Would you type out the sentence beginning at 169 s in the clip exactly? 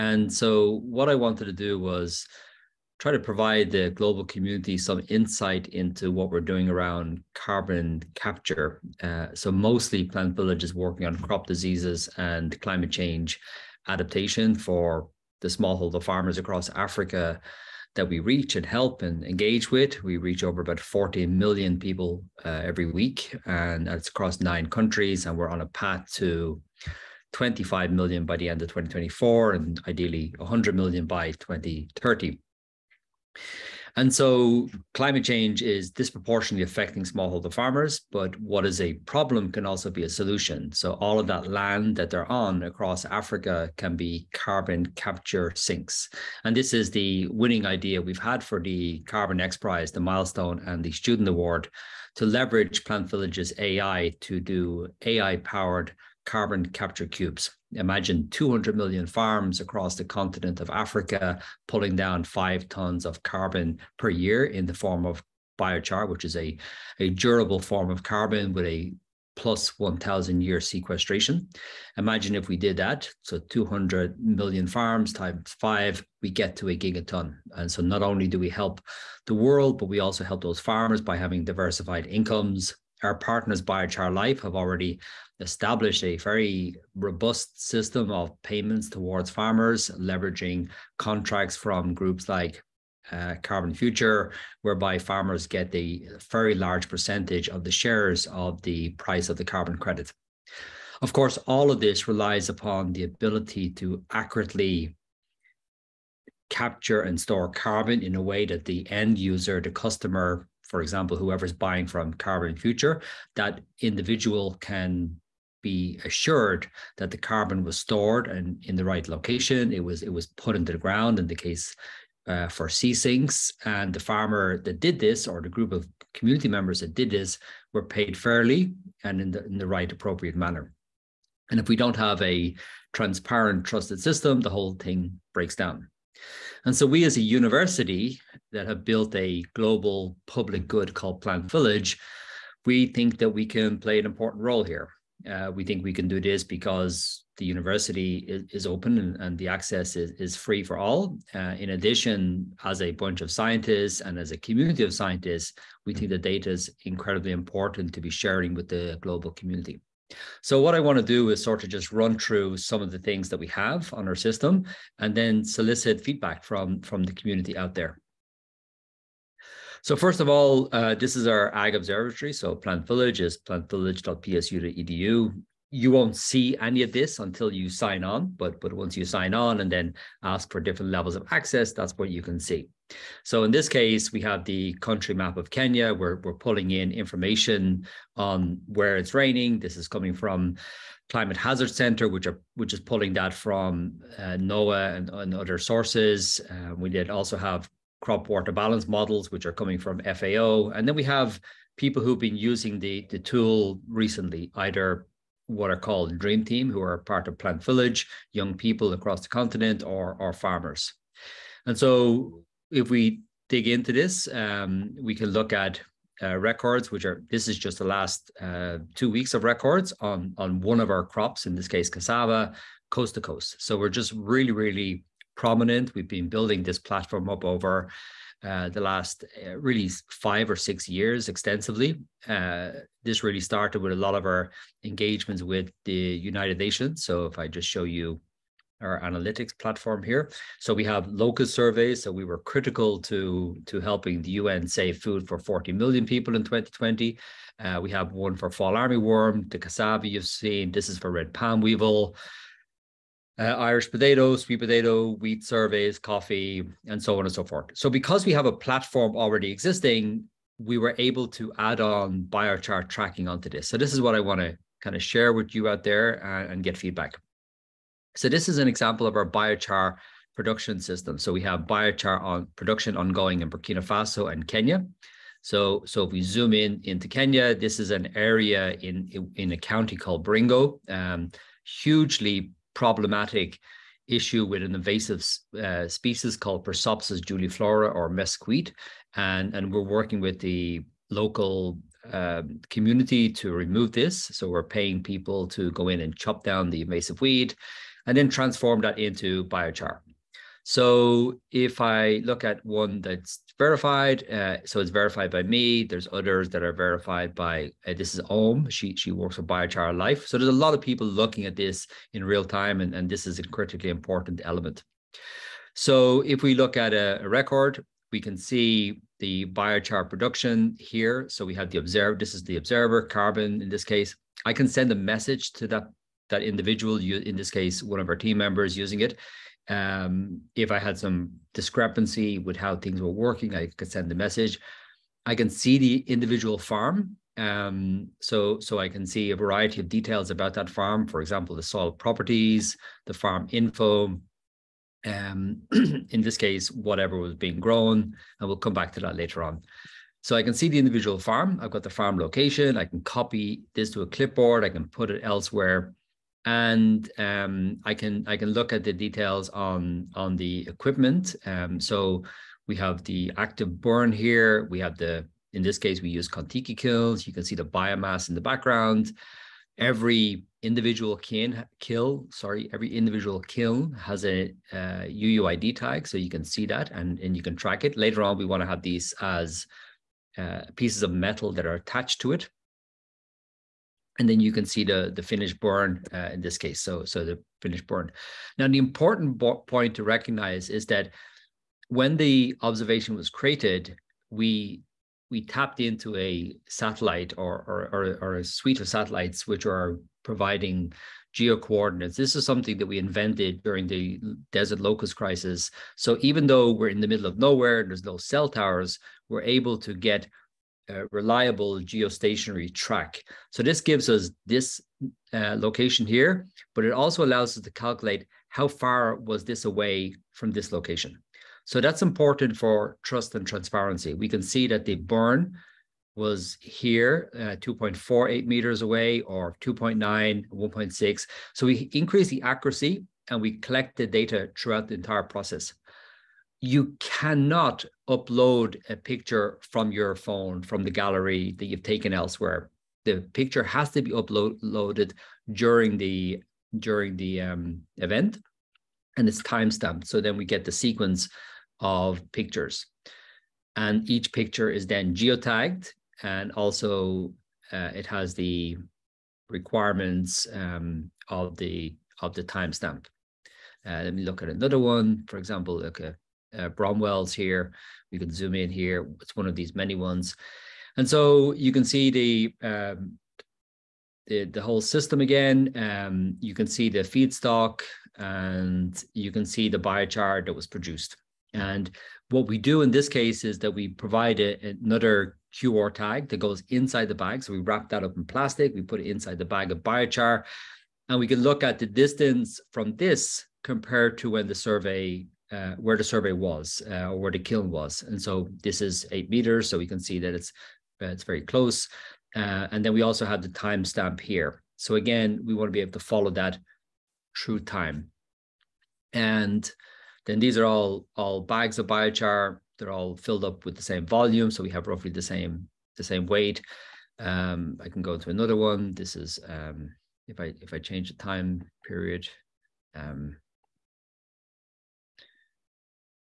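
So first of all, uh, this is our Ag Observatory.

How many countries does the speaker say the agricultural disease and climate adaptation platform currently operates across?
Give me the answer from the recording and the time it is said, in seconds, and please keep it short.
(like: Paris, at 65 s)
9, at 24 s.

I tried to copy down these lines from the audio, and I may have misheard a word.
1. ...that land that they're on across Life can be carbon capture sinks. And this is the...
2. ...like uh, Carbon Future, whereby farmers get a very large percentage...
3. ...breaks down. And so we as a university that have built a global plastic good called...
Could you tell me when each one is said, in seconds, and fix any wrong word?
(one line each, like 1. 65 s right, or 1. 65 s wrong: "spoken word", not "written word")
1. 41 s wrong: "Africa", not "Life"
2. 92 s right
3. 135 s wrong: "public", not "plastic".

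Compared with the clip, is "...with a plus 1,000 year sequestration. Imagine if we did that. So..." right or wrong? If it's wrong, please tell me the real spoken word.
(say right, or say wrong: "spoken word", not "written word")
right.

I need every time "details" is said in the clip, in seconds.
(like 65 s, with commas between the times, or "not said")
339 s, 358 s.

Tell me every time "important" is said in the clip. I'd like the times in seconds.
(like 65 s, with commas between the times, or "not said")
144 s, 157 s, 313 s, 388 s, 422 s.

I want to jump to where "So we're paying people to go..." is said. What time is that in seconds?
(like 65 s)
294 s.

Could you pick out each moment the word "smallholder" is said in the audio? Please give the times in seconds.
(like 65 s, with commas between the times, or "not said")
15 s, 37 s.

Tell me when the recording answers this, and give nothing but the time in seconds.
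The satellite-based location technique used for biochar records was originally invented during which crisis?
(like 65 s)
404 s.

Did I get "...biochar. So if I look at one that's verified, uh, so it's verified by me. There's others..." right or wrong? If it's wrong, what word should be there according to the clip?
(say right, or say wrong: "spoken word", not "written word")
right.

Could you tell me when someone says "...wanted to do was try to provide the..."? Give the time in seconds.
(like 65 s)
1 s.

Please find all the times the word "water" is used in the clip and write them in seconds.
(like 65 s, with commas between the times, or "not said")
198 s.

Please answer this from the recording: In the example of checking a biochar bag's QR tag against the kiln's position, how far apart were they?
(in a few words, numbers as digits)
8 meters.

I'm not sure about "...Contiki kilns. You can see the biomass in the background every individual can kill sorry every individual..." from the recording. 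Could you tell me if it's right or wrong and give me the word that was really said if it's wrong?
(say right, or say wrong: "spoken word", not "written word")
right.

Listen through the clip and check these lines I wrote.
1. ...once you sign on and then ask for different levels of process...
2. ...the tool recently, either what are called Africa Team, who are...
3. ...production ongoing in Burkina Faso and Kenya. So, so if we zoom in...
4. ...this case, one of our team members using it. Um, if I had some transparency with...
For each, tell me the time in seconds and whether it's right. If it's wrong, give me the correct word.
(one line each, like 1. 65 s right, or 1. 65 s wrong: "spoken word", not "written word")
1. 178 s wrong: "access", not "process"
2. 203 s wrong: "Dream", not "Africa"
3. 272 s right
4. 327 s wrong: "discrepancy", not "transparency".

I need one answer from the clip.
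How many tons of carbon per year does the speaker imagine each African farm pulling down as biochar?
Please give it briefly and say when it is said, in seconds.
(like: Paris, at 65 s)
5, at 62 s.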